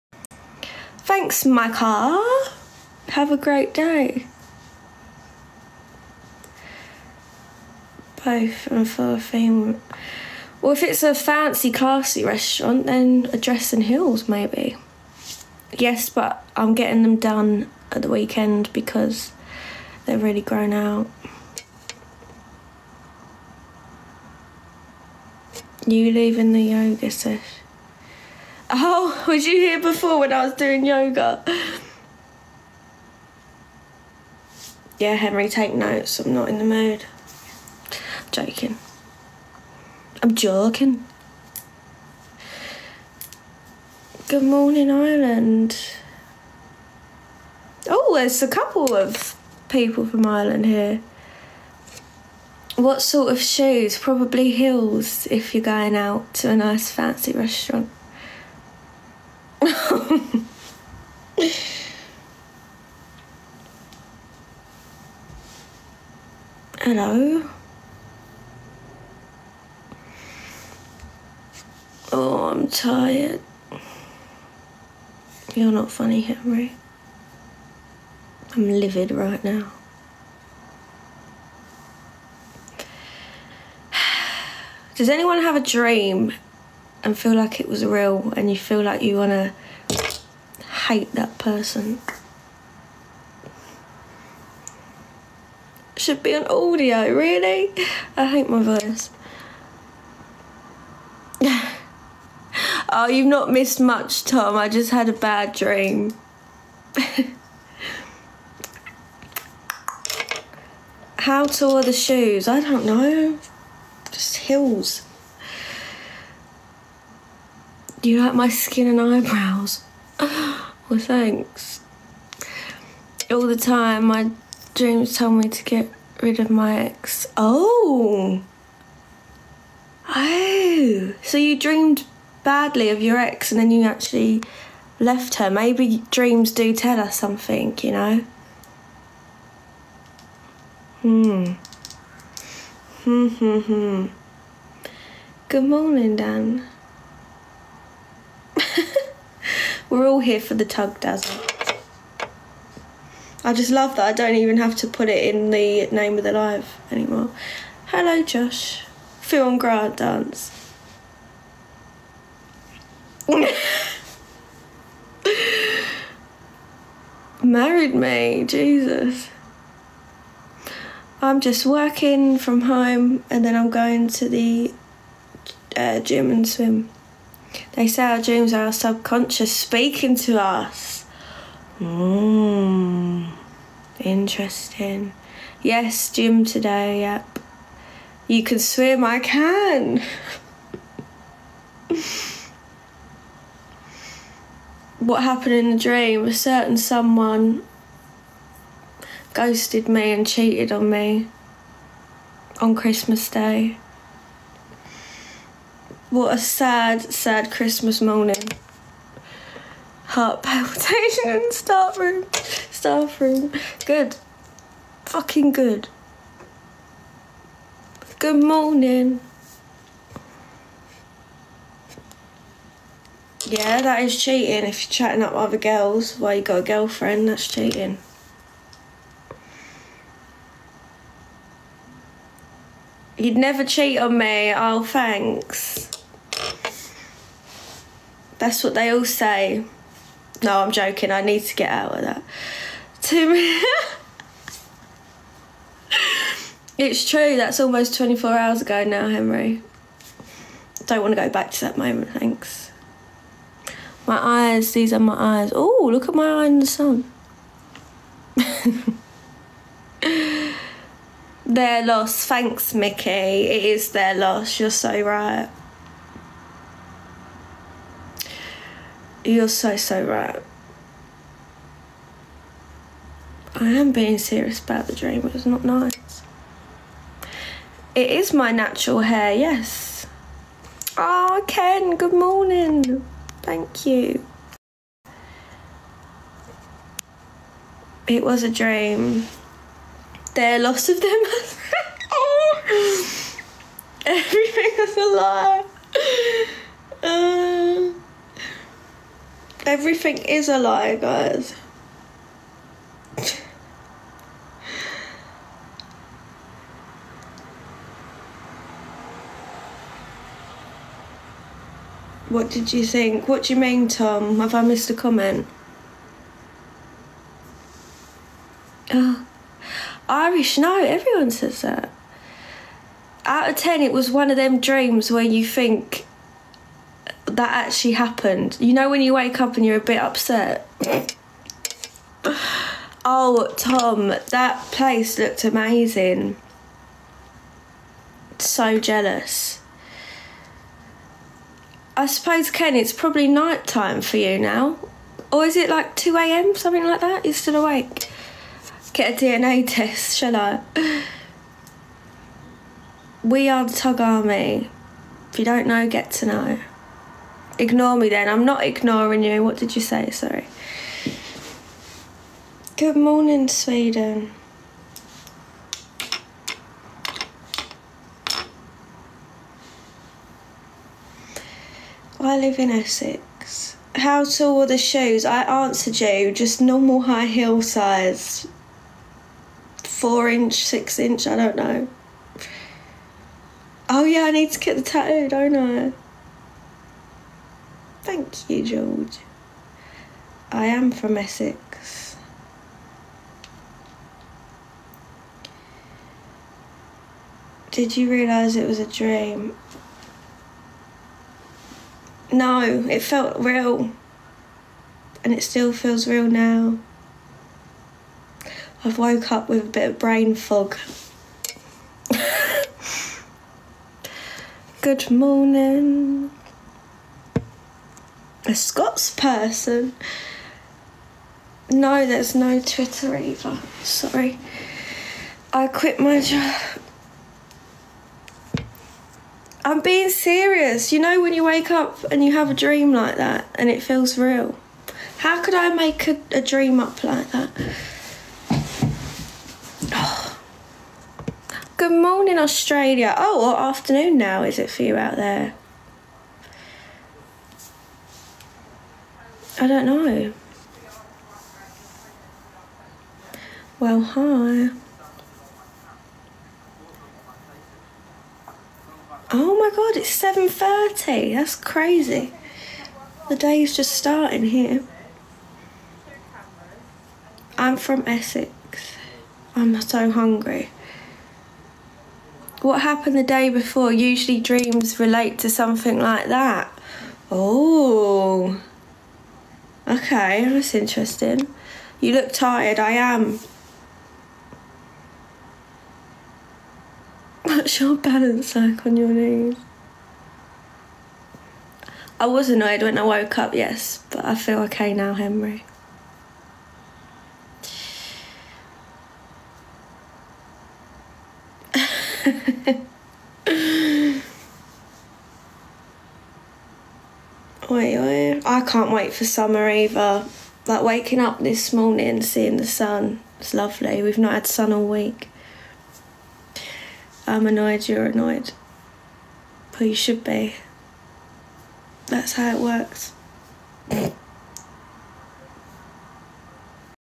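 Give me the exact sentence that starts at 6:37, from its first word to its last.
Did you realise it was a dream?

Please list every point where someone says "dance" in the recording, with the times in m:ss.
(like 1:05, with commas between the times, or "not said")
2:39.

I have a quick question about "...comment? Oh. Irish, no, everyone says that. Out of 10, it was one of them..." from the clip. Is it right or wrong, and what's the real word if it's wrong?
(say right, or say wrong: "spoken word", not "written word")
right.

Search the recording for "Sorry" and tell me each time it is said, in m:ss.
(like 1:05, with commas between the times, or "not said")
6:00, 7:03.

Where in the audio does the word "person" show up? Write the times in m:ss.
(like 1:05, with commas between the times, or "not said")
1:31, 6:59.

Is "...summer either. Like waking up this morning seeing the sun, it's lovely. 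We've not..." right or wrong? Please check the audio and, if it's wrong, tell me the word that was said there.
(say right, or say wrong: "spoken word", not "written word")
right.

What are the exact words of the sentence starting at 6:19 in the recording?
Four inch, six inch, I don't know.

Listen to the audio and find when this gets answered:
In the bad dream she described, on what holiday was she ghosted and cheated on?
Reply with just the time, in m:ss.
3:22.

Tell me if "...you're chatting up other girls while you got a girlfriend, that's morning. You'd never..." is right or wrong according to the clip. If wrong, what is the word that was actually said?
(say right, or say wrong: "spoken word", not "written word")
wrong: "cheating", not "morning".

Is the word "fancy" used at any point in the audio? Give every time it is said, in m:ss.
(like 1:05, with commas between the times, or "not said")
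0:11, 0:56.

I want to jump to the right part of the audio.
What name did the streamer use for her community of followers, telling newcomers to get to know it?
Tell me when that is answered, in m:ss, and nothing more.
5:53.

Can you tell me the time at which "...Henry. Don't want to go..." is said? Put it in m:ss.
4:09.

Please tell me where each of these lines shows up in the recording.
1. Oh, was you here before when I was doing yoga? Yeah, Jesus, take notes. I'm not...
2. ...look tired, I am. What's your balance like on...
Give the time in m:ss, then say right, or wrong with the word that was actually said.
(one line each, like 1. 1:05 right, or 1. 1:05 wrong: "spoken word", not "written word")
1. 0:28 wrong: "Henry", not "Jesus"
2. 8:02 right.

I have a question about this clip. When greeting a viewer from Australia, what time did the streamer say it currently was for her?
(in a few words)
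7.30.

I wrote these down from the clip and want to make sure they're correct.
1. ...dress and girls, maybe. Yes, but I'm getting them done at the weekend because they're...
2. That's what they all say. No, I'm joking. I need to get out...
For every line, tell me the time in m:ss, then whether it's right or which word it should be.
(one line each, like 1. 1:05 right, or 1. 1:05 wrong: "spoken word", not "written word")
1. 0:13 wrong: "heels", not "girls"
2. 3:58 right.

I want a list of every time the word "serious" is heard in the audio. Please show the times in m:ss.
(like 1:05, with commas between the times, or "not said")
4:34, 7:10.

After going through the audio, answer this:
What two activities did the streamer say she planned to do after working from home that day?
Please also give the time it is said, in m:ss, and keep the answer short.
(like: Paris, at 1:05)
Gym and swim, at 2:55.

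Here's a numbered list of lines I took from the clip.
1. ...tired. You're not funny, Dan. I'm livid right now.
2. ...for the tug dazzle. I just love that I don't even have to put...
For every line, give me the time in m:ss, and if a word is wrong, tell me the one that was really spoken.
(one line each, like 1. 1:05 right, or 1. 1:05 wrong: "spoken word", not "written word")
1. 1:12 wrong: "Henry", not "Dan"
2. 2:30 right.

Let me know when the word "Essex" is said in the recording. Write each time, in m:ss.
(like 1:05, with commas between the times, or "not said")
6:12, 6:31, 7:48.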